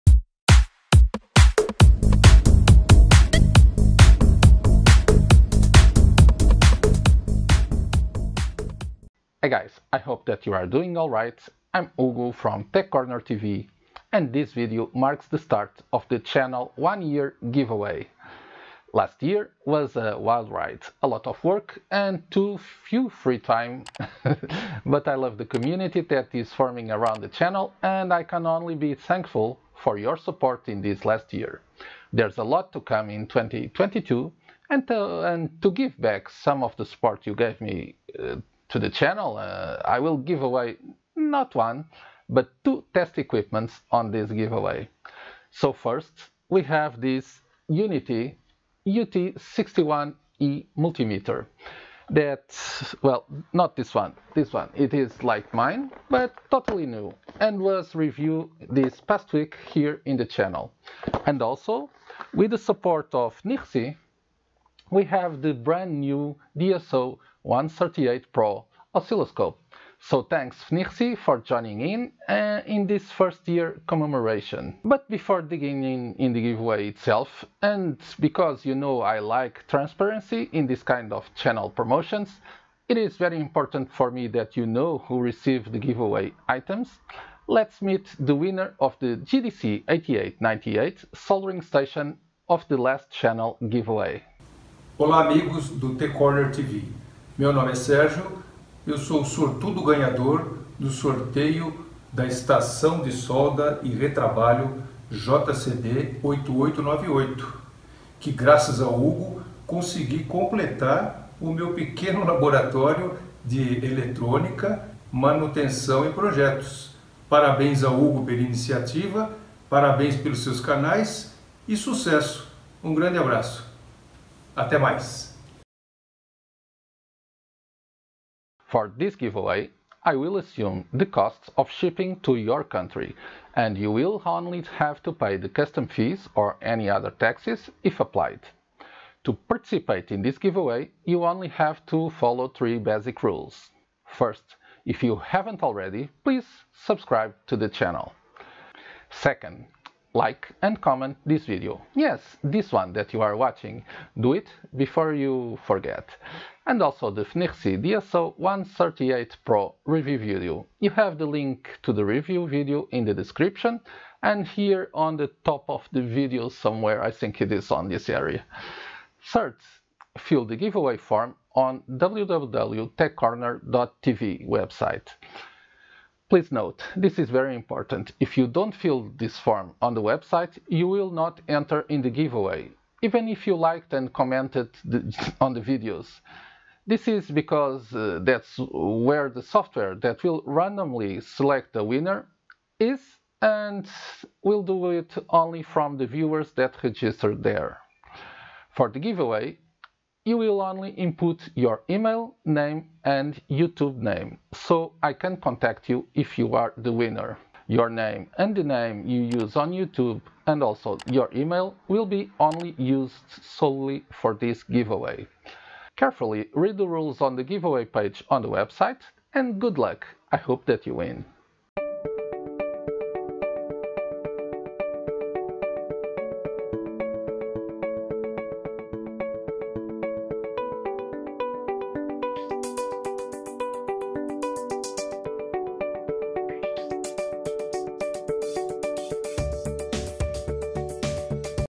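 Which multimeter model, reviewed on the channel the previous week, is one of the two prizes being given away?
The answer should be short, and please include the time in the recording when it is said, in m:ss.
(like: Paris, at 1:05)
Uni-T UT61E, at 0:47.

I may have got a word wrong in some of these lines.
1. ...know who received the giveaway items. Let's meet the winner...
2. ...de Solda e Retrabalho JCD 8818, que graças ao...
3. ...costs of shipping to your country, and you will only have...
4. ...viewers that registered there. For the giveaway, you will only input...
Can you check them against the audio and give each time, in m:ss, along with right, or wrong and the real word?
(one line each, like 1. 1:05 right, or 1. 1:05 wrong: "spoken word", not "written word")
1. 1:24 right
2. 1:43 wrong: "8898", not "8818"
3. 2:11 right
4. 3:16 right.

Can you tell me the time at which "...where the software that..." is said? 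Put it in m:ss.
3:08.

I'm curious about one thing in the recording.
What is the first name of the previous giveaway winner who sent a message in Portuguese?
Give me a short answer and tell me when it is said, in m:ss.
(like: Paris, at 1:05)
Sérgio, at 1:37.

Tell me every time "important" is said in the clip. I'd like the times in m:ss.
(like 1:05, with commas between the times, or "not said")
1:23, 2:57.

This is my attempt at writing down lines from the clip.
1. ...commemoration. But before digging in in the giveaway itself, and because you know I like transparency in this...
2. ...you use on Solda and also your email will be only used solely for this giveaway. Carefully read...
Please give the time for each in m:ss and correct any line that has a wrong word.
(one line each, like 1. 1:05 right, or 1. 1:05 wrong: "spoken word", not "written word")
1. 1:13 right
2. 3:29 wrong: "YouTube", not "Solda".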